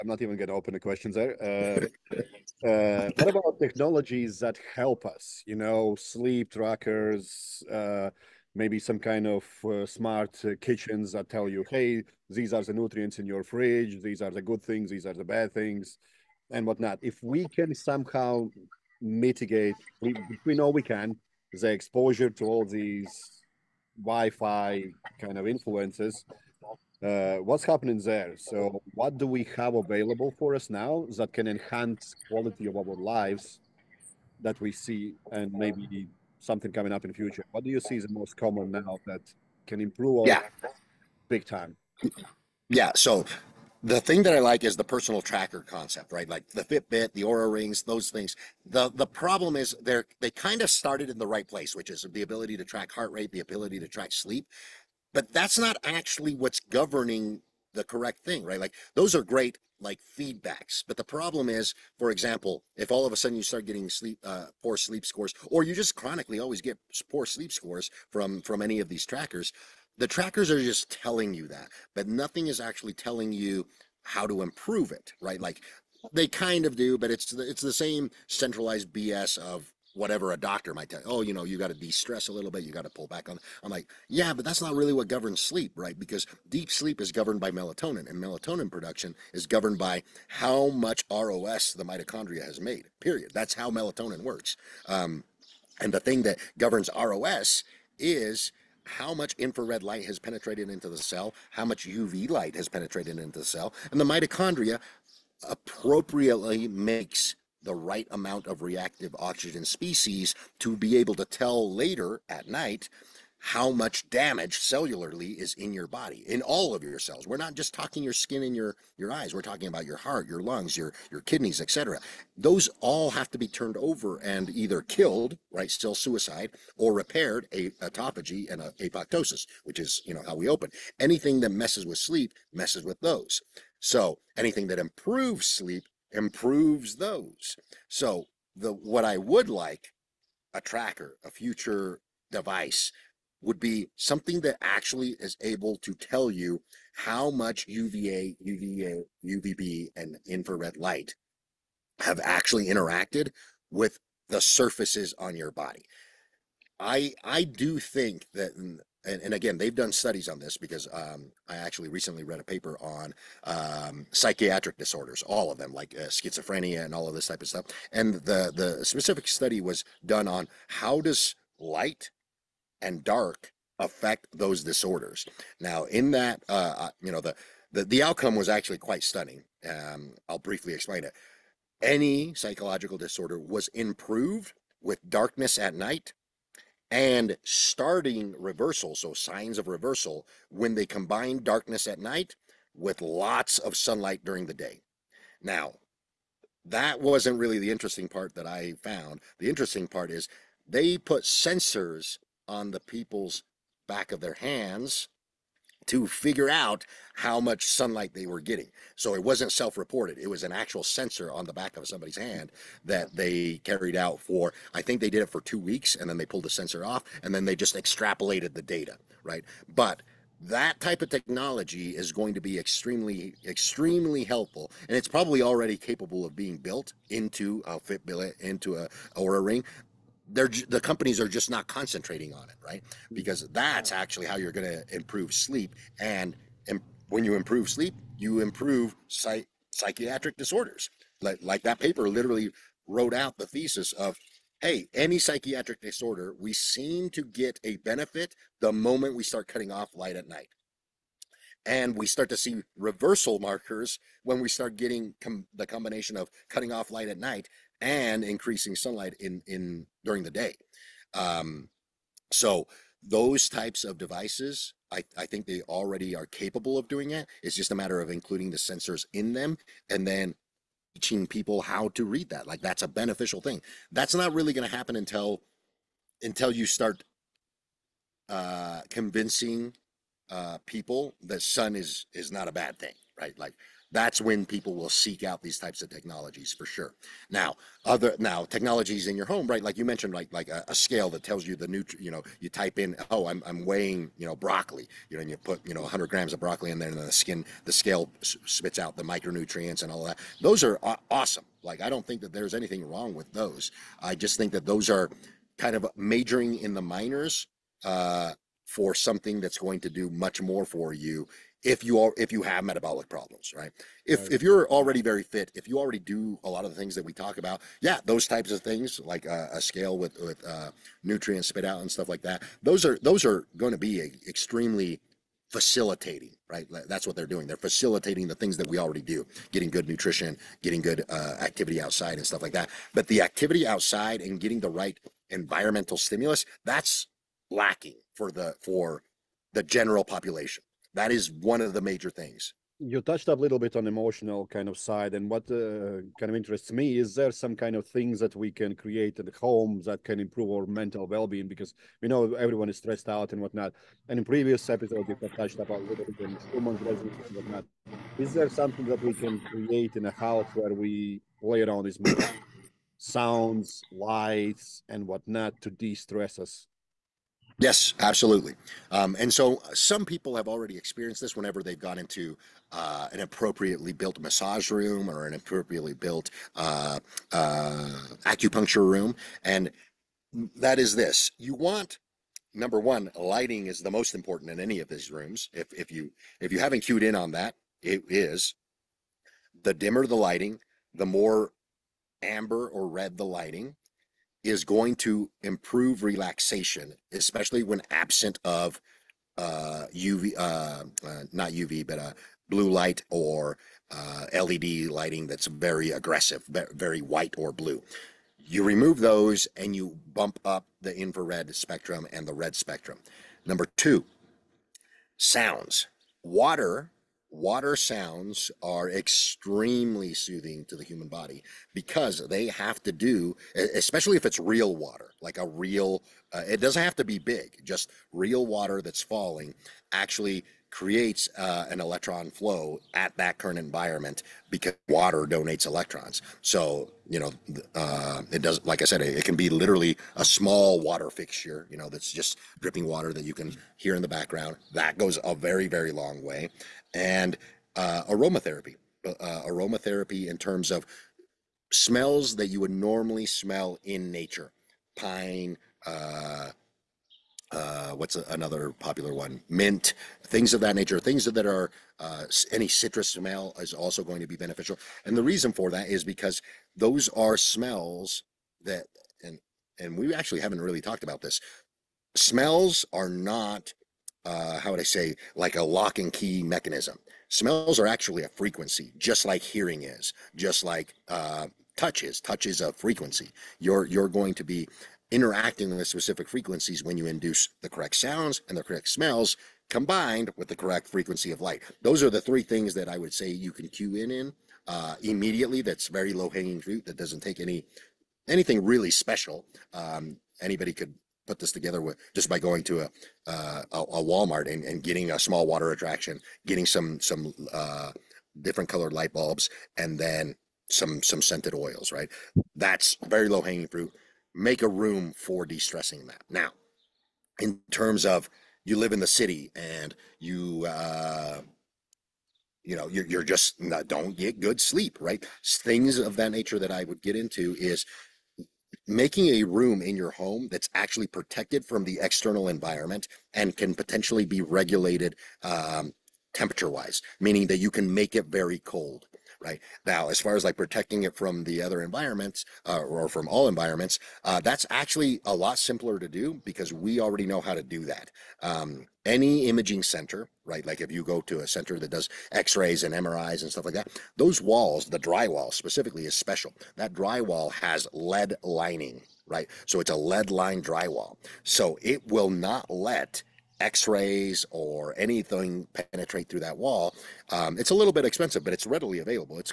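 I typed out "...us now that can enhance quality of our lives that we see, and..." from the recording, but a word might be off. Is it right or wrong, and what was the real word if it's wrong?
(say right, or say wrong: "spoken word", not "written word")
right.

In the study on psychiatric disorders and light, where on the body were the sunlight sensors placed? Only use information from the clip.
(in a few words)
back of their hands.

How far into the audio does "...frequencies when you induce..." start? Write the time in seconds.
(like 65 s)
486 s.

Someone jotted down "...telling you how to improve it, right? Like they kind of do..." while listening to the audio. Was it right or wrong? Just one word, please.
right.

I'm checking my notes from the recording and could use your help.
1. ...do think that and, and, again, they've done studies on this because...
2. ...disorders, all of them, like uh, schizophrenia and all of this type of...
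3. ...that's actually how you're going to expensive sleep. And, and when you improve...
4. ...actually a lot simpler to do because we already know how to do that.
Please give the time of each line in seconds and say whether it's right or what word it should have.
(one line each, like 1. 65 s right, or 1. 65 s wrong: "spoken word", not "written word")
1. 157 s right
2. 164 s right
3. 233 s wrong: "improve", not "expensive"
4. 544 s right.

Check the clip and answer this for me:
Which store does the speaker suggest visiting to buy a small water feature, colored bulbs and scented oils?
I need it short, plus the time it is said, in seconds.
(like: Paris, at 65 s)
Walmart, at 504 s.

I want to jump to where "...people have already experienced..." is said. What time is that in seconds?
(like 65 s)
370 s.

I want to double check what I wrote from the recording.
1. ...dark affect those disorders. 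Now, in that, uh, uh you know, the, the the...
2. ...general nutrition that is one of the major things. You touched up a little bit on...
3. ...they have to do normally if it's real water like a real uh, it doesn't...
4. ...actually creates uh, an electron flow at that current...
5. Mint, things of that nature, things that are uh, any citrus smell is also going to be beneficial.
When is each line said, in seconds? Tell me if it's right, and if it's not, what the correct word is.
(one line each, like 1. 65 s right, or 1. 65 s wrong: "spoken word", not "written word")
1. 173 s right
2. 339 s wrong: "population", not "nutrition"
3. 422 s wrong: "especially", not "normally"
4. 429 s right
5. 459 s right.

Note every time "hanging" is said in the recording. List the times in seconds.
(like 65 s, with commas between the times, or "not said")
496 s, 513 s.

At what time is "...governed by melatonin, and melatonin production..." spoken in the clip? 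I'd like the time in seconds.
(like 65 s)
87 s.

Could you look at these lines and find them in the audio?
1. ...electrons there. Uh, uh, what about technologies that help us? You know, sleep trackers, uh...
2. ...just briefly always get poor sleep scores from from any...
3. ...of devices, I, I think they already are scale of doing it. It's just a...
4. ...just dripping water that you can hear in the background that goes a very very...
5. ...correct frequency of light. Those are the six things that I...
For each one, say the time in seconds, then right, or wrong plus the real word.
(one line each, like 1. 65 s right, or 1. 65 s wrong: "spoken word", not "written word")
1. 0 s wrong: "questions", not "electrons"
2. 65 s wrong: "chronically", not "briefly"
3. 263 s wrong: "capable", not "scale"
4. 442 s right
5. 490 s wrong: "three", not "six".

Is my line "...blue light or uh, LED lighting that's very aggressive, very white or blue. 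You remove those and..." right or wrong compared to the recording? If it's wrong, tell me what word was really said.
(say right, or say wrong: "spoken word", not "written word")
right.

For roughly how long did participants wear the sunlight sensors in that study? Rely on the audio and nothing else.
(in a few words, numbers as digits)
two weeks.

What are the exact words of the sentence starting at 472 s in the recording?
Smells are not uh, how would I say, like a lock and key mechanism.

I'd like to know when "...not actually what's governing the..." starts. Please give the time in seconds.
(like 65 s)
55 s.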